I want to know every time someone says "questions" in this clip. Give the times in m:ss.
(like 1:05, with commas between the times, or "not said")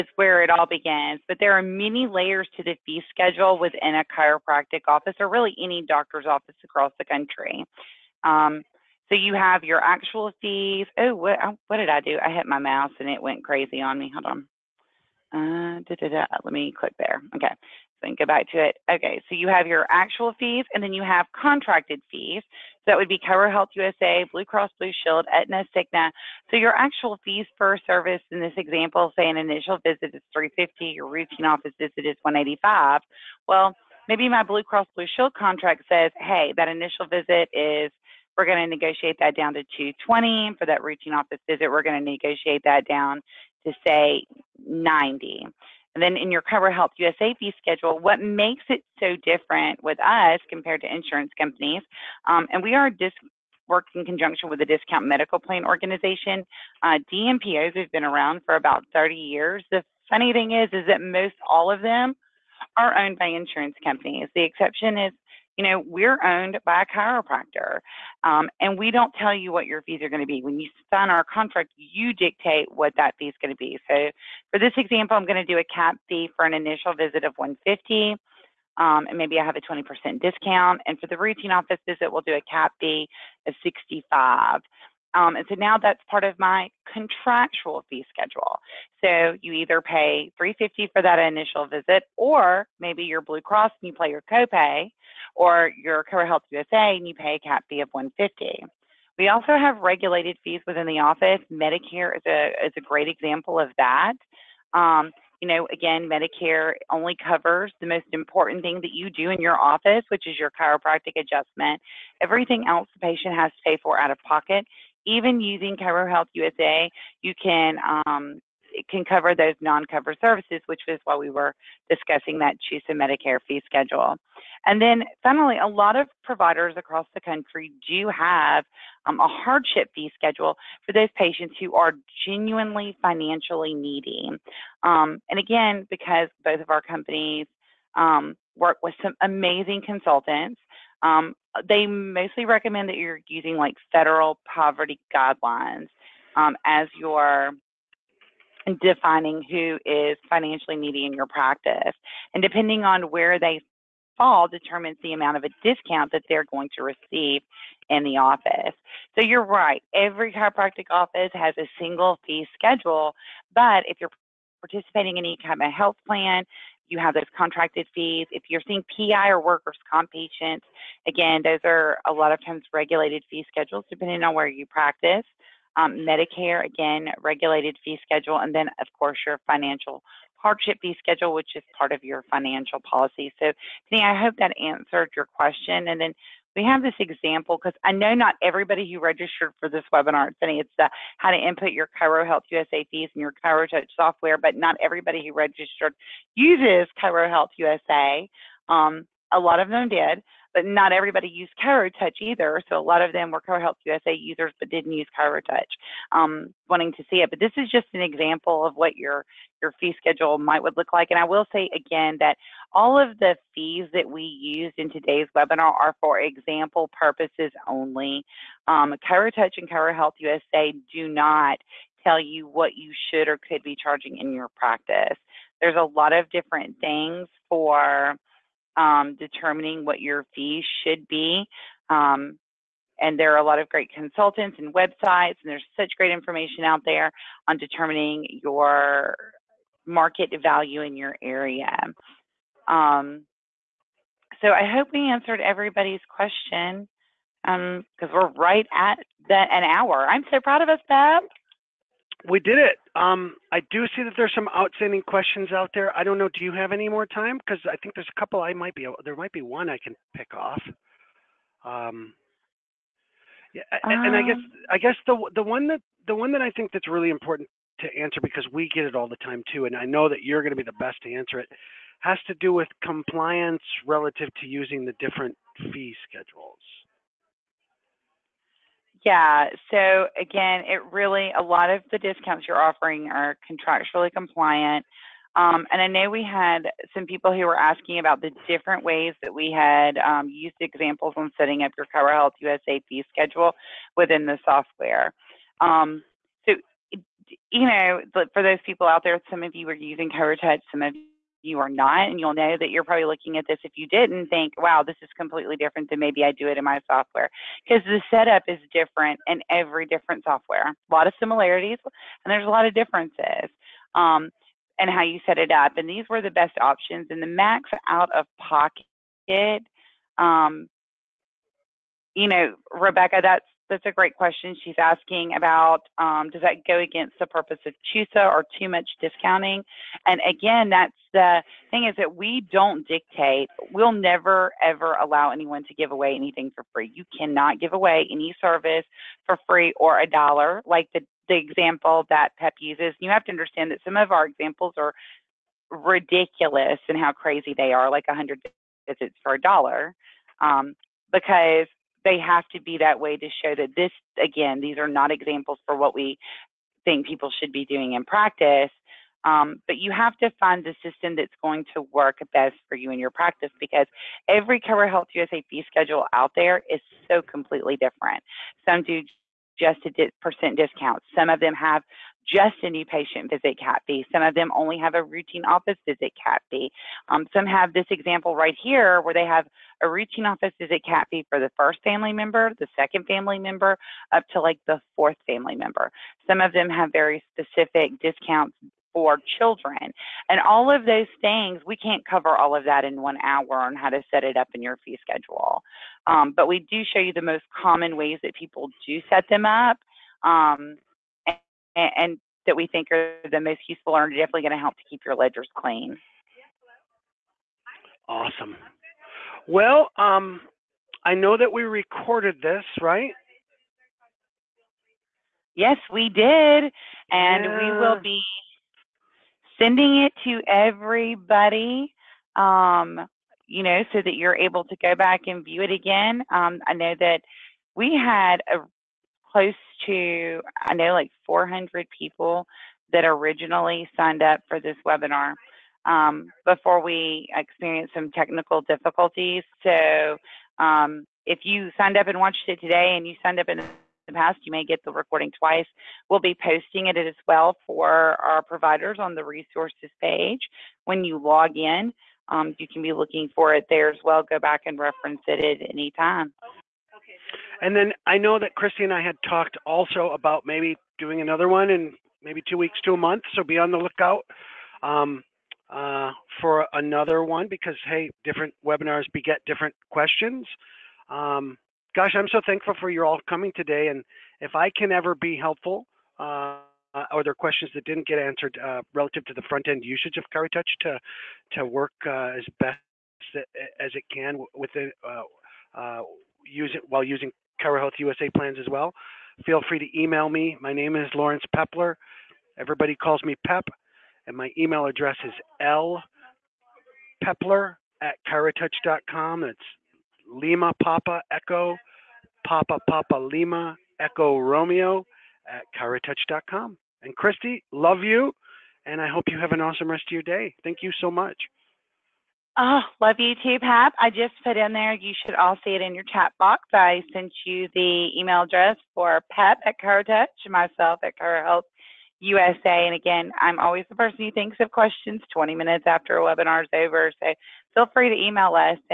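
3:05, 4:06, 4:15, 5:24, 7:49, 7:57, 8:44.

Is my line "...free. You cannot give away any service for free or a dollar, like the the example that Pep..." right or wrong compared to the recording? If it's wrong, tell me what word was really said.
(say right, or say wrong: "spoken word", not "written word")
right.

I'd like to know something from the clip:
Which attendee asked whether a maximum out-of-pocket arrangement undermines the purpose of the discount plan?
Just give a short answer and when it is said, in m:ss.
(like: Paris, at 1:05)
Rebecca, at 5:22.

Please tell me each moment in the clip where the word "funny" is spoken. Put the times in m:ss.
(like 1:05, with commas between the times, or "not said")
1:00.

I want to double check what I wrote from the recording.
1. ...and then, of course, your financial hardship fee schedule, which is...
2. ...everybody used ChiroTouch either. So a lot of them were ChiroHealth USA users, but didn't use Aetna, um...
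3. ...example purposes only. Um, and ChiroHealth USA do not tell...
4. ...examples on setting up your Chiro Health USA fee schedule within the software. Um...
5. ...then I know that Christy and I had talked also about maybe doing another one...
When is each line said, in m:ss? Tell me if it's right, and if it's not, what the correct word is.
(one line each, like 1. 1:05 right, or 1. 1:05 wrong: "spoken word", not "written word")
1. 2:58 right
2. 3:20 wrong: "ChiroTouch", not "Aetna"
3. 3:36 right
4. 4:50 right
5. 7:37 right.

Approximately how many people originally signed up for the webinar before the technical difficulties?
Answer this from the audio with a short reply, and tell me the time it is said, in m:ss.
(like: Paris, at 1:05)
400, at 7:11.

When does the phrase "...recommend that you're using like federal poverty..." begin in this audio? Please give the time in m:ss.
2:22.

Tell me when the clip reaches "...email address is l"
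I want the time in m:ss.
8:14.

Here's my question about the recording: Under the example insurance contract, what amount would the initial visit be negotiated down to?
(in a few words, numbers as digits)
220.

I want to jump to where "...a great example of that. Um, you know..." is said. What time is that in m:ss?
1:42.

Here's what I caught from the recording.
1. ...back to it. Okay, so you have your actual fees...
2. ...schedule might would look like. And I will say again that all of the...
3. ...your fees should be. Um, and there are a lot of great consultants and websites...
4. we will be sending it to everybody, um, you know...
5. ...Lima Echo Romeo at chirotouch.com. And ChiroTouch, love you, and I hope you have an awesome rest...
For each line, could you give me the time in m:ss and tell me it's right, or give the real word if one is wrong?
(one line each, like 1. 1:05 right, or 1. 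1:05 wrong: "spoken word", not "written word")
1. 0:18 right
2. 3:29 right
3. 3:50 right
4. 6:57 right
5. 8:23 wrong: "Christy", not "ChiroTouch".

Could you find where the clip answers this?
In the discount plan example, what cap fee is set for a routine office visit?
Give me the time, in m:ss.
1:22.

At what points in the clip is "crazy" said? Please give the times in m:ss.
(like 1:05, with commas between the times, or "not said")
0:13, 5:47.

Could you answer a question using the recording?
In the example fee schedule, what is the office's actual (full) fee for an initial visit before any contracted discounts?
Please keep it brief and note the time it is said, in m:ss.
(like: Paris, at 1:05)
350, at 0:30.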